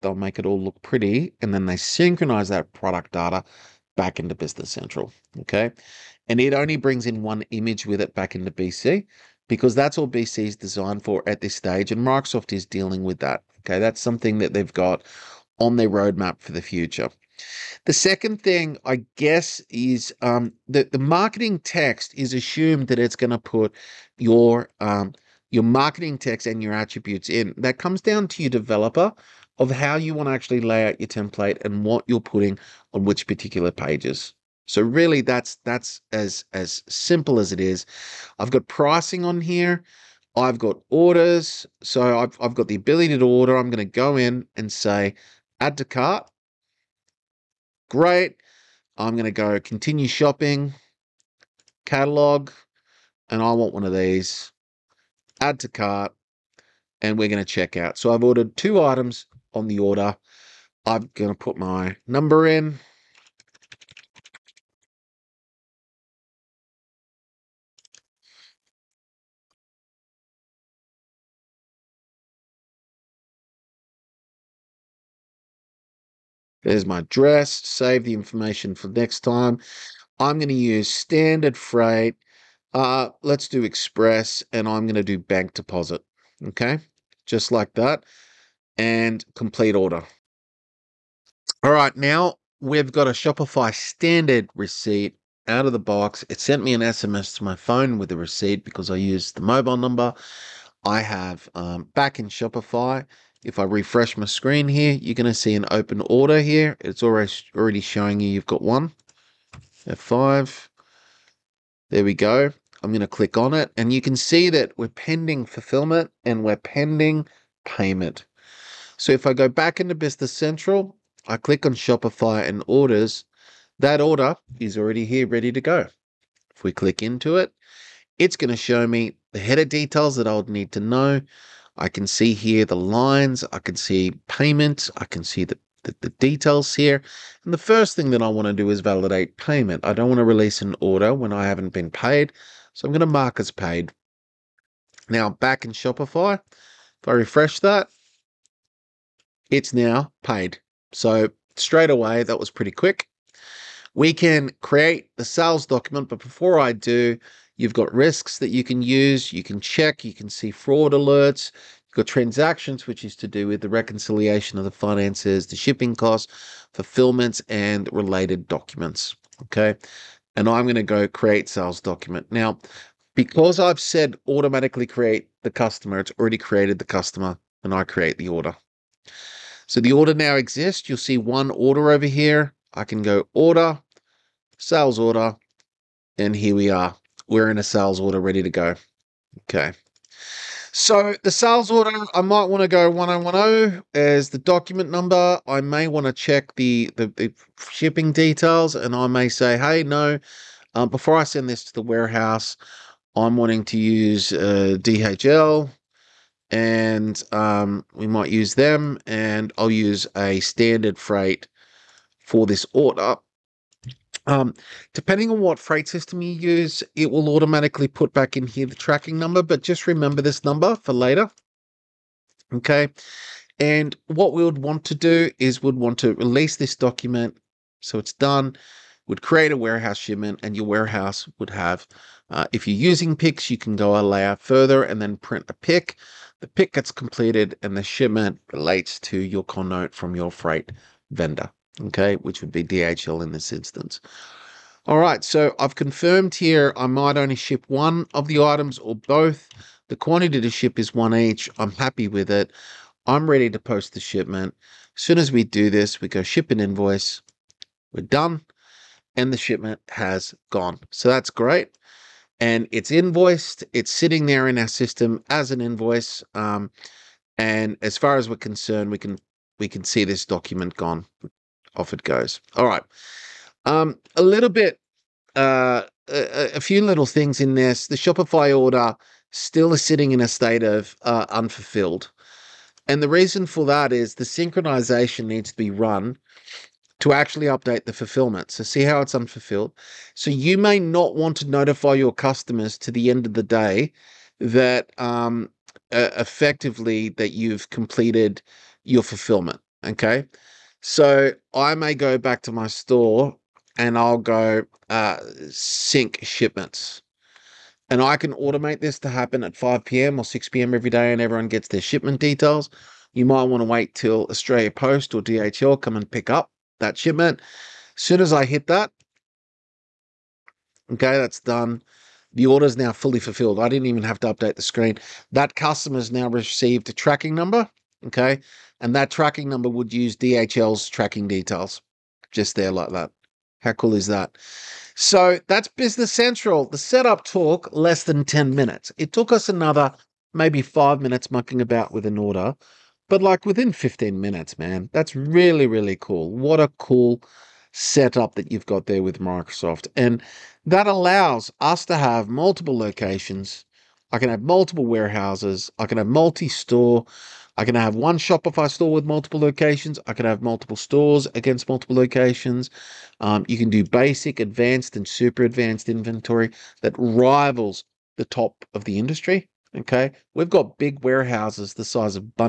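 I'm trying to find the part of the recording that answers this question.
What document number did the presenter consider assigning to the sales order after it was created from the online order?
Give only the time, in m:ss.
3:12.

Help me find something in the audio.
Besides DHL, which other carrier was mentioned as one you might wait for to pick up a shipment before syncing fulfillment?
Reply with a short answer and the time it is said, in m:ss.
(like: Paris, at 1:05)
Australia Post, at 5:14.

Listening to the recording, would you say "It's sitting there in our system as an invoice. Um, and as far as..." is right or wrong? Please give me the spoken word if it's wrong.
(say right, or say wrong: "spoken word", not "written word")
right.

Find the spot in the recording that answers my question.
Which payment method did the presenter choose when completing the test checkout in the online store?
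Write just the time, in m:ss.
1:25.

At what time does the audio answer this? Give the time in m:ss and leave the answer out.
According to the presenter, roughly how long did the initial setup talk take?
5:37.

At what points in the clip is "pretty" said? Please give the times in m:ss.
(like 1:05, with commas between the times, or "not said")
0:00, 2:32.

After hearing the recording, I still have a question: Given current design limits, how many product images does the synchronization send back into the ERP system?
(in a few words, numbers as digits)
1.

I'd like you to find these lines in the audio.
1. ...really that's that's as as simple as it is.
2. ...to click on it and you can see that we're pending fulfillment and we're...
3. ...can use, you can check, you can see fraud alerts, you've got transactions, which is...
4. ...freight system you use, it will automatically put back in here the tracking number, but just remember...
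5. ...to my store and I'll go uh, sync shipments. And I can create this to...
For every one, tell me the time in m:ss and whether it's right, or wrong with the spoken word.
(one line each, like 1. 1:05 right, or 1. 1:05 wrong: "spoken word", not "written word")
1. 0:34 right
2. 1:53 right
3. 2:38 right
4. 3:35 right
5. 5:02 wrong: "automate", not "create".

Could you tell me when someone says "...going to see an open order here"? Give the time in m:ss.
1:45.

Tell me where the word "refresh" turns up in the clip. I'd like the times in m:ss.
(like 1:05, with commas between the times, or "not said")
1:43, 2:27.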